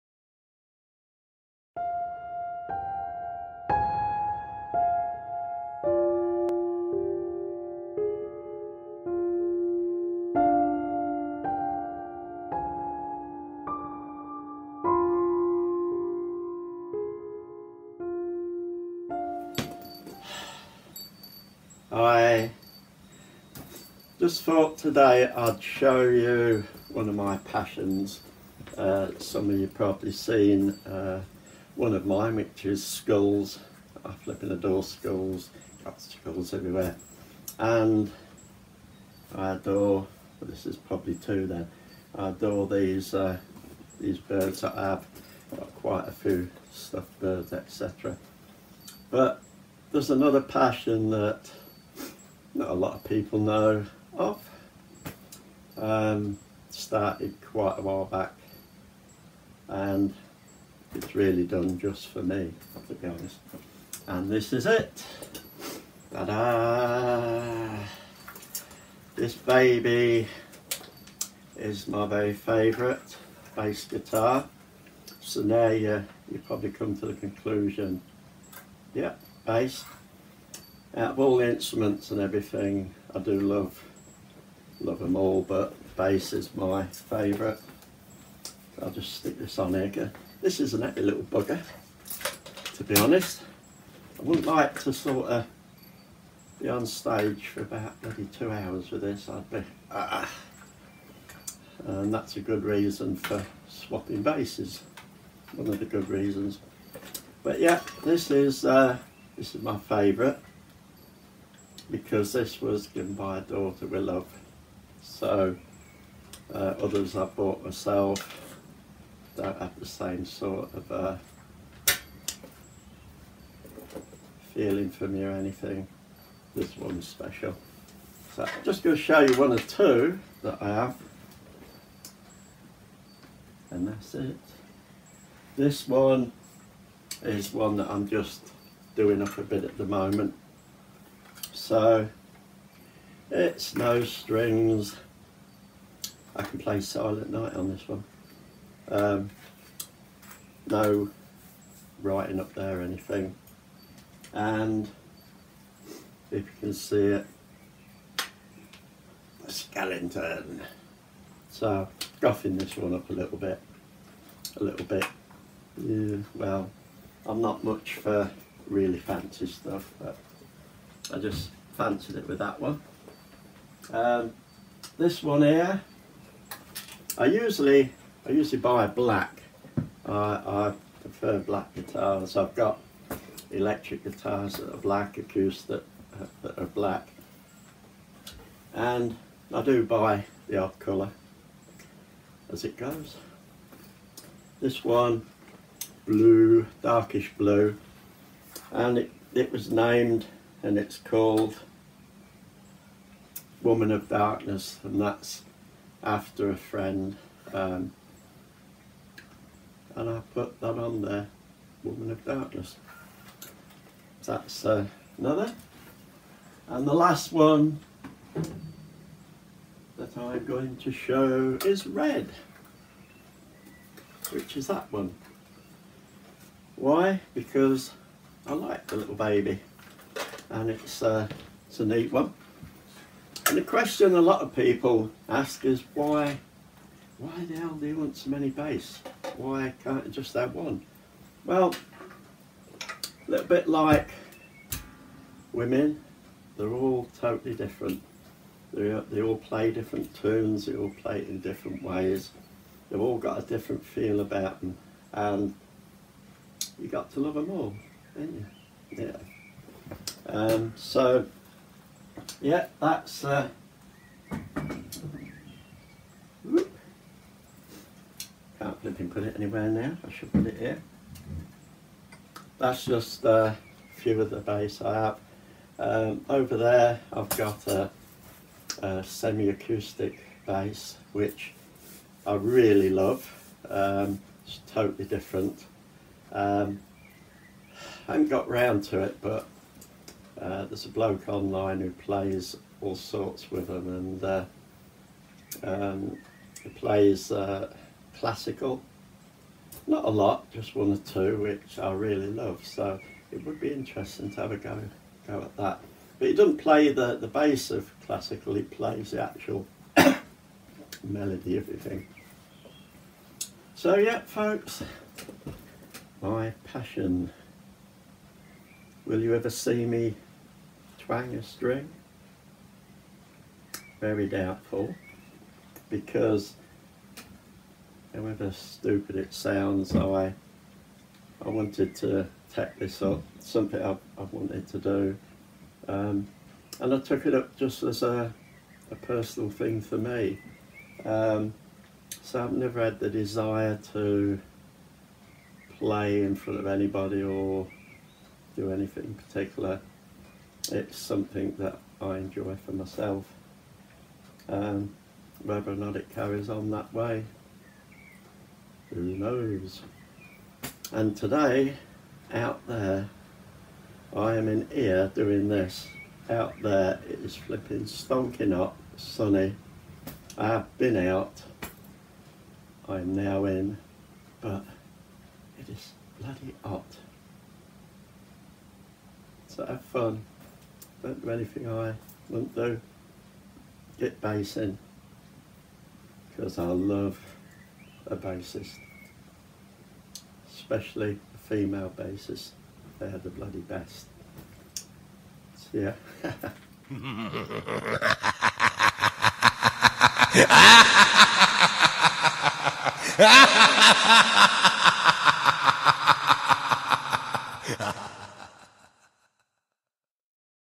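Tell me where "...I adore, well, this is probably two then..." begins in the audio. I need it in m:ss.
0:39.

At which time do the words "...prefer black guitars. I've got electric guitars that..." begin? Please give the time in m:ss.
3:01.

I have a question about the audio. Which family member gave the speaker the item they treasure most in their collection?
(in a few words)
daughter.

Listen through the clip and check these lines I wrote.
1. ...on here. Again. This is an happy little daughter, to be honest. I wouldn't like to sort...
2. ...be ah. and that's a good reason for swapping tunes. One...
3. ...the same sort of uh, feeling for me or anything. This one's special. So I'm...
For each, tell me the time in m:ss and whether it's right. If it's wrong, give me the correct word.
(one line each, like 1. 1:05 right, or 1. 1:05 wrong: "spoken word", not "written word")
1. 1:29 wrong: "bugger", not "daughter"
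2. 1:39 wrong: "basses", not "tunes"
3. 1:59 right.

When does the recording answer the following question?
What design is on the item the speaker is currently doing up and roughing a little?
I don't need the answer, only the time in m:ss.
2:39.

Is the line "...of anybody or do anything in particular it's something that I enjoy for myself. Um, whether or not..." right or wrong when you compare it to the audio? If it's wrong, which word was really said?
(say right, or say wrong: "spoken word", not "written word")
right.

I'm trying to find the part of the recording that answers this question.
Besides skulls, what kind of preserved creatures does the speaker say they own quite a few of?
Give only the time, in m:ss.
0:46.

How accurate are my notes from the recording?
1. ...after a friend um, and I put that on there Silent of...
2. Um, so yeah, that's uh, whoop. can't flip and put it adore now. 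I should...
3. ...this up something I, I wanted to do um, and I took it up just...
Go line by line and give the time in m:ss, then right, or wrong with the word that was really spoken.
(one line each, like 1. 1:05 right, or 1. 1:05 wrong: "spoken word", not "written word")
1. 3:26 wrong: "Woman", not "Silent"
2. 4:20 wrong: "anywhere", not "adore"
3. 5:32 right.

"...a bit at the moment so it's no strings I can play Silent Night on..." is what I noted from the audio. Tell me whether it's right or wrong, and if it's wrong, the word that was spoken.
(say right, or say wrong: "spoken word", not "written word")
right.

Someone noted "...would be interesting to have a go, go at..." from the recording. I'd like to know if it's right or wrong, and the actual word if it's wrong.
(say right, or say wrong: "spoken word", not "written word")
right.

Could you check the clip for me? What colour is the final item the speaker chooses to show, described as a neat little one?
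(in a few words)
red.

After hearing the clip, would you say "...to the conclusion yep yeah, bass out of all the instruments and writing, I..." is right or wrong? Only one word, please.
wrong.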